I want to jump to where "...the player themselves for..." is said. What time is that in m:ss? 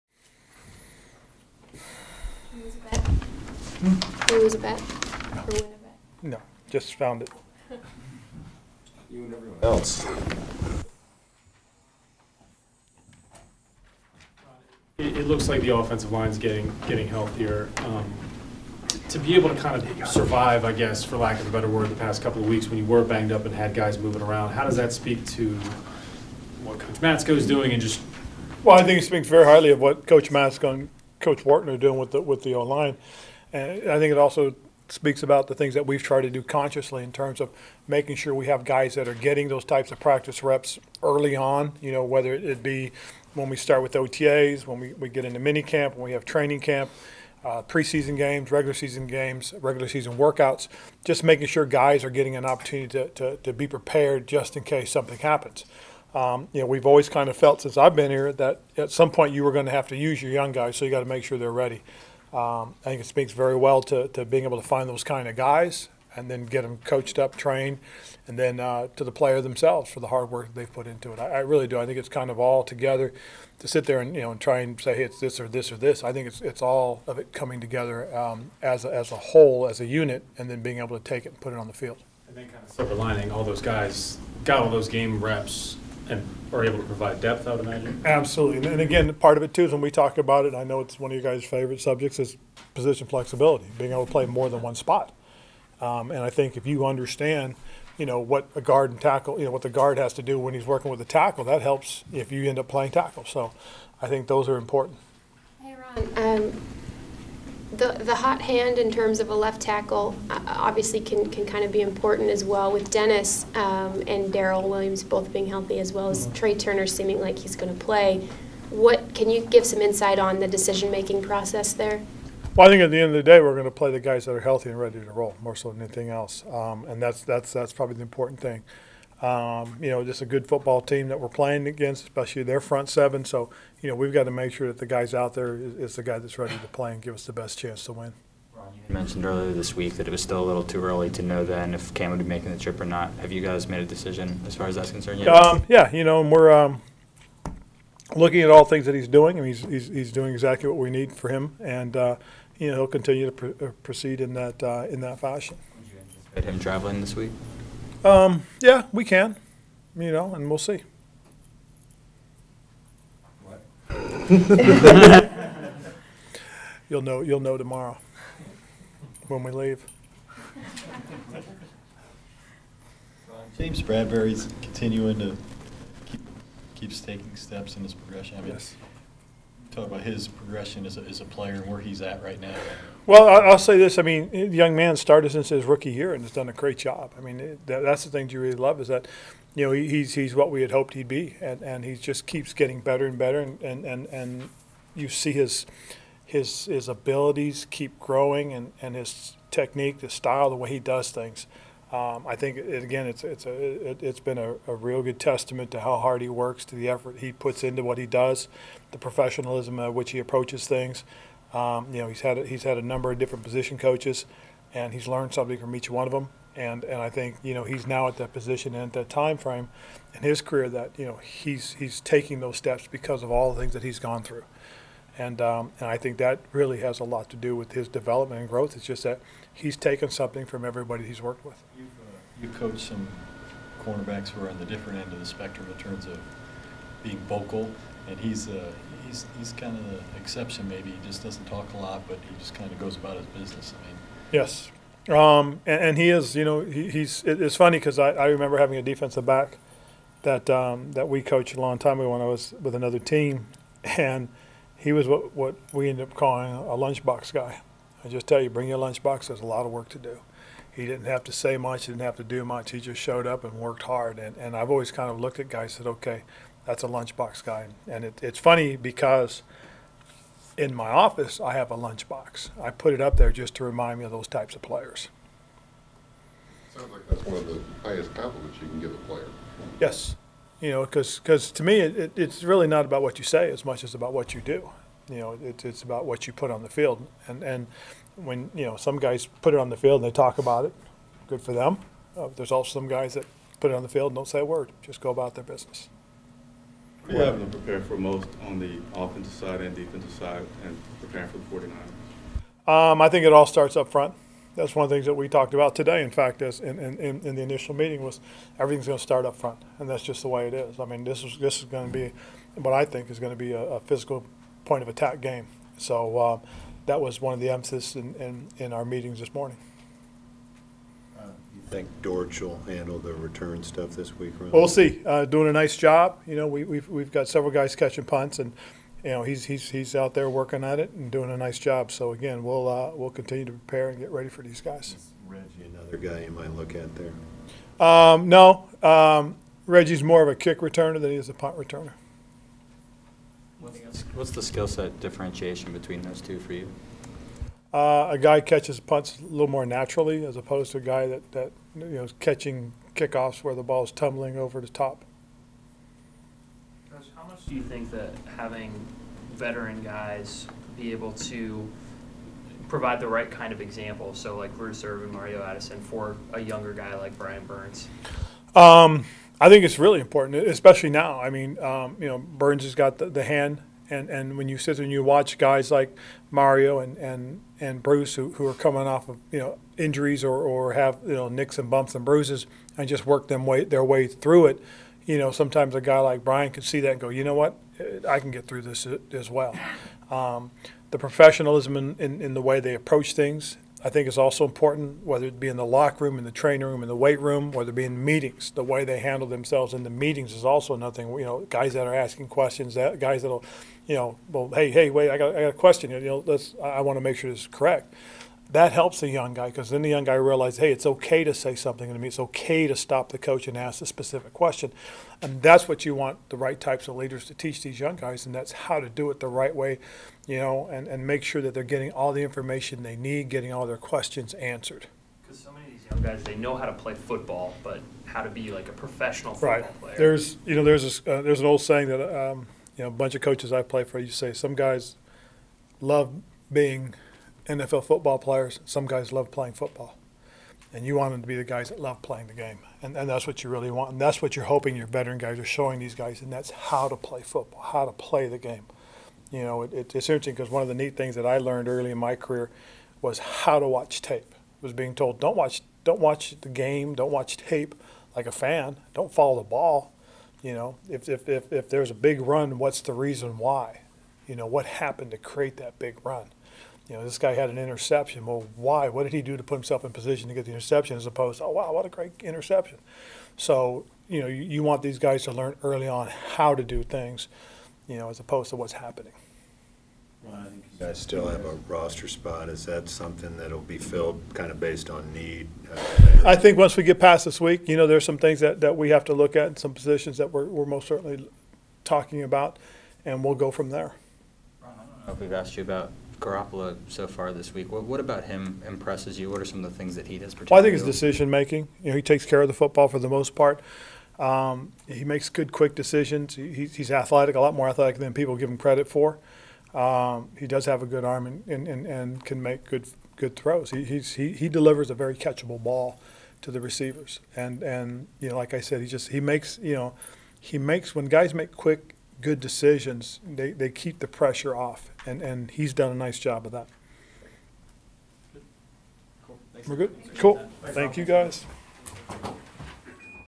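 1:09.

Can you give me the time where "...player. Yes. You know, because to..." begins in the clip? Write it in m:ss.
4:38.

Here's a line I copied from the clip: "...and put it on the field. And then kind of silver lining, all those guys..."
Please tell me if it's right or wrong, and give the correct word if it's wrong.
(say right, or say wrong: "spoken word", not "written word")
right.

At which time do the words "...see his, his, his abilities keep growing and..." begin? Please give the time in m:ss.
3:15.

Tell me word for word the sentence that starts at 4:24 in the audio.
And, and I've always kind of looked at guys and said, okay, that's a lunchbox guy.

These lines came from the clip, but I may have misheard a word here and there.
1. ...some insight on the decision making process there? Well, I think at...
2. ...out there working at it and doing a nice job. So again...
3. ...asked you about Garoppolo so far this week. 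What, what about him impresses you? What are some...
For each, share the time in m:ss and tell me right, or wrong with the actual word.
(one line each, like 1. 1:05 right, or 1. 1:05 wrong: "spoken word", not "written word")
1. 1:59 right
2. 5:29 right
3. 8:15 right.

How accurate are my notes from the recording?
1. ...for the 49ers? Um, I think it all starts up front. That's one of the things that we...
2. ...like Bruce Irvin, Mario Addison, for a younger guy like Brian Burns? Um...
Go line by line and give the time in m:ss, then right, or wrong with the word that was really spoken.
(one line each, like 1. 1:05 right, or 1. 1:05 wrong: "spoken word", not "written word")
1. 5:01 right
2. 6:04 right.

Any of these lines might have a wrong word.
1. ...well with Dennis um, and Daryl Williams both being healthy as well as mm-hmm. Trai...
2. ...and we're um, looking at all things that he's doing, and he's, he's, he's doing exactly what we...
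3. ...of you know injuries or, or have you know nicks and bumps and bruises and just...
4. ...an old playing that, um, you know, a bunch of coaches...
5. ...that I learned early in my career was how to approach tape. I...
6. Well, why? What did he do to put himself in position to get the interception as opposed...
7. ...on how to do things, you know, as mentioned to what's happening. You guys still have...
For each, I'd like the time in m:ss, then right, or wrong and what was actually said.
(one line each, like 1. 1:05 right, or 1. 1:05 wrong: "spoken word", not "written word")
1. 1:52 right
2. 2:26 right
3. 6:19 right
4. 7:11 wrong: "saying", not "playing"
5. 7:31 wrong: "watch", not "approach"
6. 7:48 right
7. 7:55 wrong: "opposed", not "mentioned".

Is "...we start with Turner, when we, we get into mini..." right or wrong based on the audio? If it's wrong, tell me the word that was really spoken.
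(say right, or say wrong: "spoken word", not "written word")
wrong: "OTAs", not "Turner".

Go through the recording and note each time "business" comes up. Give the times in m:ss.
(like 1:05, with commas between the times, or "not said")
4:03, 4:55.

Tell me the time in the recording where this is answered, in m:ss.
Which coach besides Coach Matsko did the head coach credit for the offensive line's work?
0:31.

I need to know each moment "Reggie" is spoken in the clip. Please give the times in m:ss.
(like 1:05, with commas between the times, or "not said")
5:35, 5:39.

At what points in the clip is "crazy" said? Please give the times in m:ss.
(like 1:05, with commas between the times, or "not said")
not said.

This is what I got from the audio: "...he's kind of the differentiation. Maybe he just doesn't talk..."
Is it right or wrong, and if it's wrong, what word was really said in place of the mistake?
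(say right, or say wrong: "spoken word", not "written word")
wrong: "exception", not "differentiation".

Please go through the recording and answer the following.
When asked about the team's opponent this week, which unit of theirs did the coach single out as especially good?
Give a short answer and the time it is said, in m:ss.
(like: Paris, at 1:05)
front seven, at 2:12.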